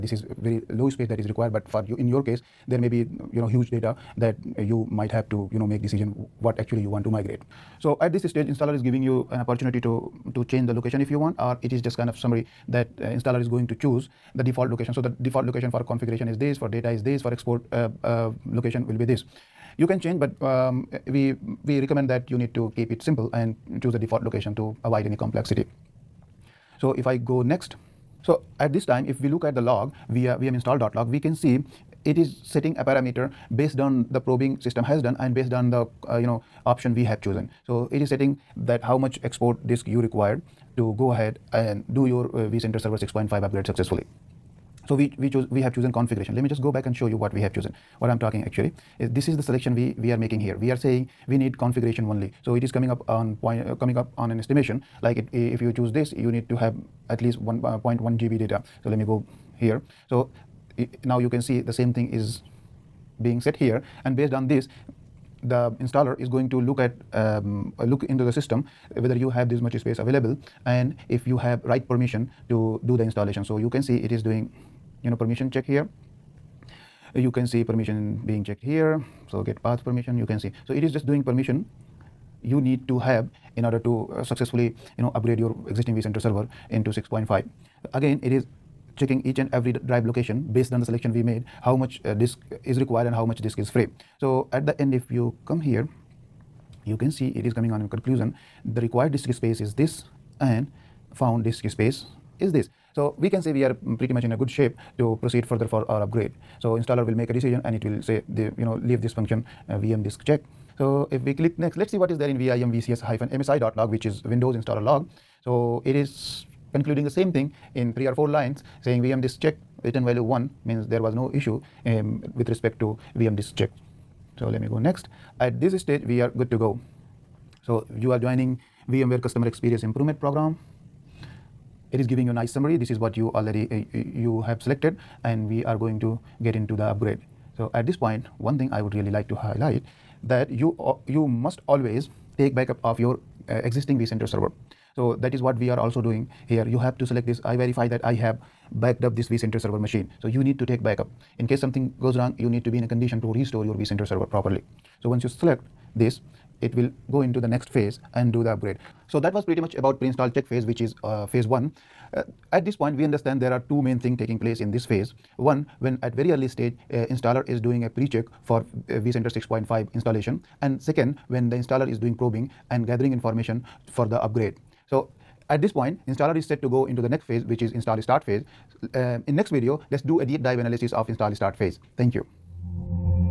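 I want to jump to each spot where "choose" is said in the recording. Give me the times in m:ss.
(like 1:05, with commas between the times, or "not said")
0:13, 0:23, 0:55.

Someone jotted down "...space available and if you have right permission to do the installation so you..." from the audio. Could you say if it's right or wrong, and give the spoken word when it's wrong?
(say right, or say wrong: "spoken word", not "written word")
right.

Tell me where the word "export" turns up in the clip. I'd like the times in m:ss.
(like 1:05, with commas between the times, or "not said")
0:17, 0:39.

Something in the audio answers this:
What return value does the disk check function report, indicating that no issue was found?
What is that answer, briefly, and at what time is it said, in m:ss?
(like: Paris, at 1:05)
1, at 2:00.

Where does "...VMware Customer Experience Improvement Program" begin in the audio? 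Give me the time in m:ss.
2:08.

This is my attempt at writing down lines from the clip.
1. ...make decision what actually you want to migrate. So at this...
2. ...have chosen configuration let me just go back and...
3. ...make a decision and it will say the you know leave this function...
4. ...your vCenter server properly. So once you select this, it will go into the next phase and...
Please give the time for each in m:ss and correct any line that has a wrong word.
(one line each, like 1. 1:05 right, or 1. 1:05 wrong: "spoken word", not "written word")
1. 0:05 right
2. 0:45 right
3. 1:47 right
4. 2:33 right.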